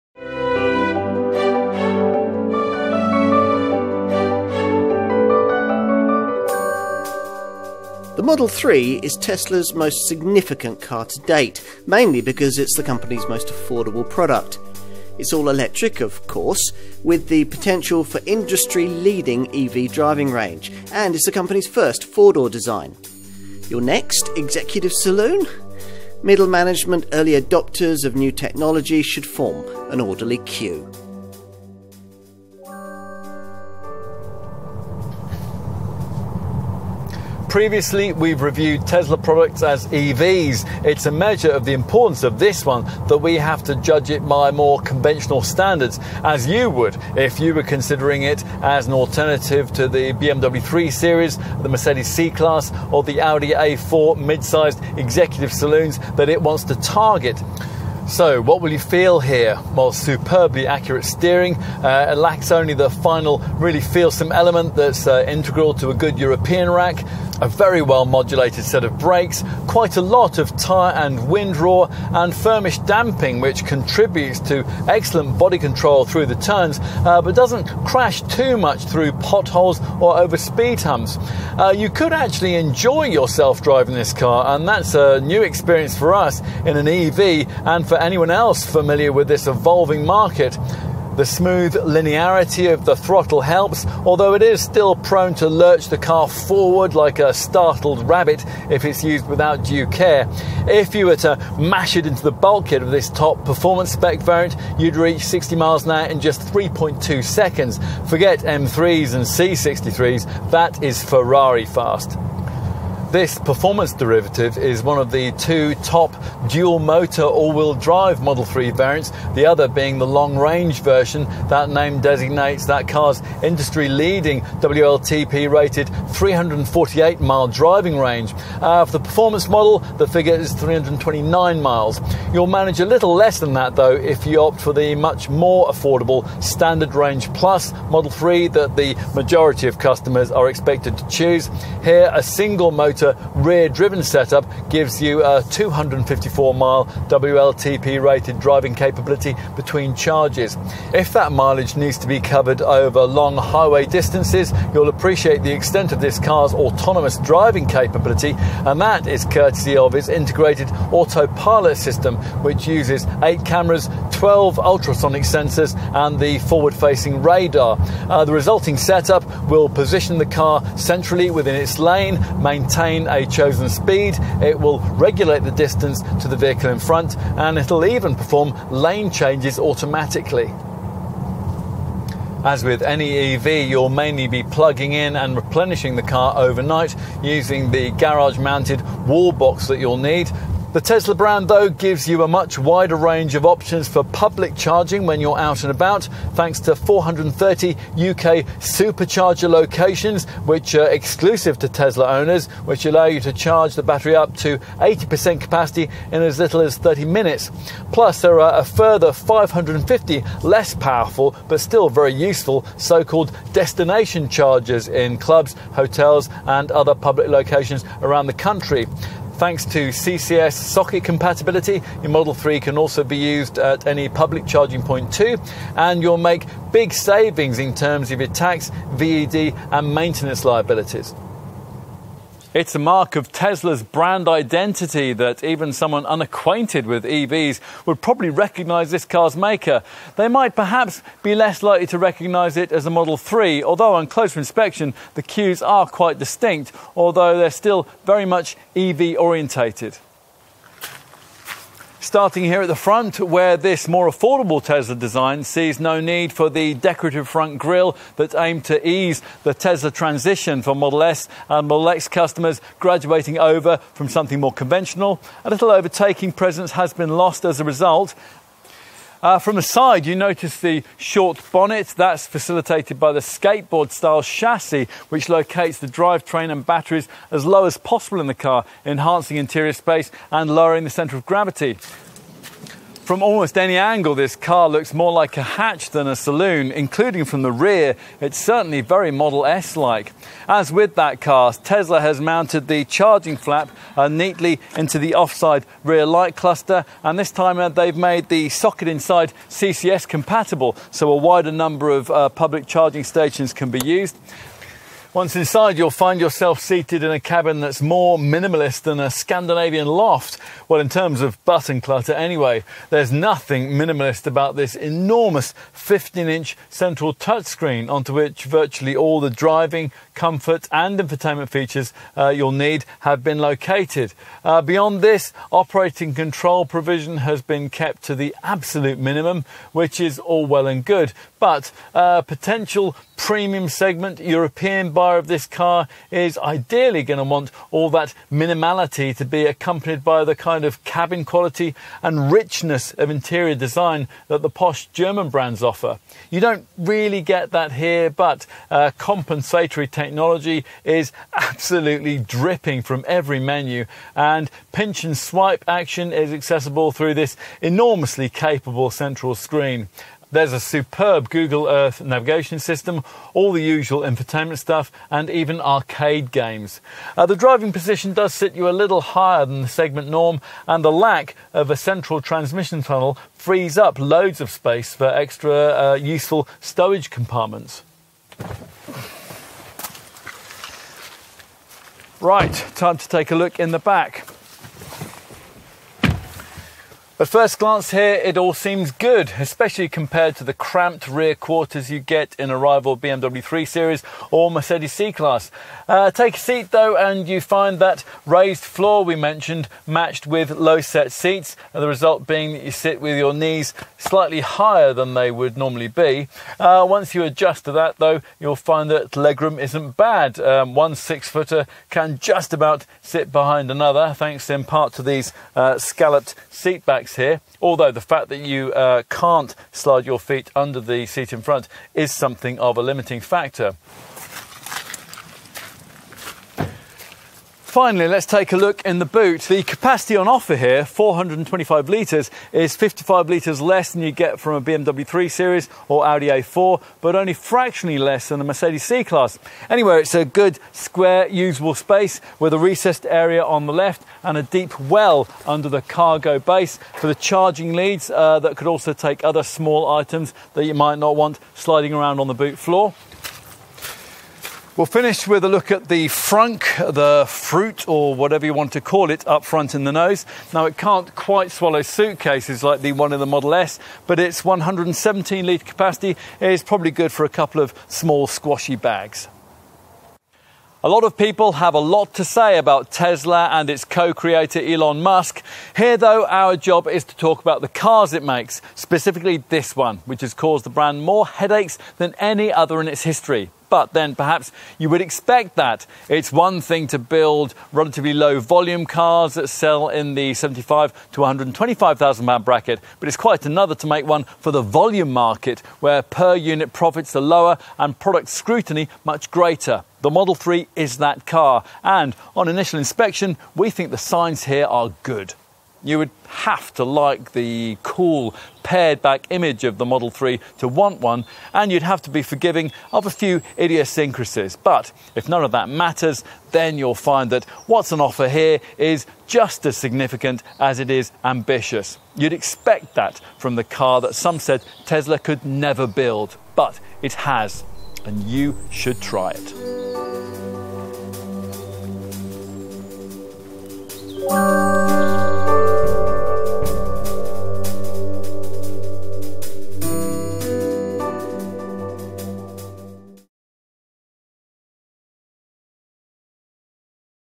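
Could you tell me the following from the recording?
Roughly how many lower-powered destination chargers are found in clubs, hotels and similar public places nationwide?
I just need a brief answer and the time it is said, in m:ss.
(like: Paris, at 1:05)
550, at 3:29.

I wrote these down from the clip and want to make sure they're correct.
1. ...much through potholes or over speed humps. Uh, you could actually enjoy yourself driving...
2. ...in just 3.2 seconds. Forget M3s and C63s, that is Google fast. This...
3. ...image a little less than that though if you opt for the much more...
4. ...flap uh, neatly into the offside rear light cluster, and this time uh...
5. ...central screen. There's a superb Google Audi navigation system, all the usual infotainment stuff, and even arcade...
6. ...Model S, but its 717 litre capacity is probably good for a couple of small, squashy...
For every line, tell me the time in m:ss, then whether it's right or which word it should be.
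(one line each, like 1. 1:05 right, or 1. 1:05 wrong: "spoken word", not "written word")
1. 1:18 right
2. 1:46 wrong: "Ferrari", not "Google"
3. 2:12 wrong: "manage", not "image"
4. 4:53 right
5. 5:58 wrong: "Earth", not "Audi"
6. 7:43 wrong: "117", not "717".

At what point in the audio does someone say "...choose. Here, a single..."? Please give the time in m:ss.
2:21.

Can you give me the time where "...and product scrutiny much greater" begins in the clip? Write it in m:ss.
8:17.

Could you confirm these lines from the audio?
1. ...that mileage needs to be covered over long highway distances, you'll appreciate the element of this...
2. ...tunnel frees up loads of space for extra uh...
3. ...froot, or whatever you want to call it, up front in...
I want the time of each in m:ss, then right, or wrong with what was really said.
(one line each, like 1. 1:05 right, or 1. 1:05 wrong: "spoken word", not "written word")
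1. 2:31 wrong: "extent", not "element"
2. 6:12 right
3. 7:37 right.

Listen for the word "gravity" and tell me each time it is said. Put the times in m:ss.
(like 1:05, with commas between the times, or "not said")
4:41.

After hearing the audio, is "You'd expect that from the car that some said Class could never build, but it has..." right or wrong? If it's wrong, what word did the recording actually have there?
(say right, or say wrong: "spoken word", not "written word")
wrong: "Tesla", not "Class".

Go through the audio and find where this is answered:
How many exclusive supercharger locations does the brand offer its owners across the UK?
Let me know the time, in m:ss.
3:16.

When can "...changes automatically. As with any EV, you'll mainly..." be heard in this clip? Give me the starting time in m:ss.
2:59.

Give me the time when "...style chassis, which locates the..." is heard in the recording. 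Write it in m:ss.
4:33.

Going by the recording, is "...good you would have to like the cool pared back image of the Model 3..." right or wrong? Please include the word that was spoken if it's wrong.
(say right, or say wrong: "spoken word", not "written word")
right.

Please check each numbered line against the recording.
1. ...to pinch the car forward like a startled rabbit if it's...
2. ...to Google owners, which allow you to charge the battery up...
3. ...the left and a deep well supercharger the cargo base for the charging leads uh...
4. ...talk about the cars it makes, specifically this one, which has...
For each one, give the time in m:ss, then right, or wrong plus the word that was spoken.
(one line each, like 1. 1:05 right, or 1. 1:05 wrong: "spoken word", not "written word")
1. 1:35 wrong: "lurch", not "pinch"
2. 3:21 wrong: "Tesla", not "Google"
3. 7:23 wrong: "under", not "supercharger"
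4. 7:57 right.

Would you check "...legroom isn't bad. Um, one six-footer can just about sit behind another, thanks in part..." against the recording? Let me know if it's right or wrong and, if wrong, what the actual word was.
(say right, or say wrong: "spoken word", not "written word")
right.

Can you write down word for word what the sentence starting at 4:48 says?
It's certainly very Model S like.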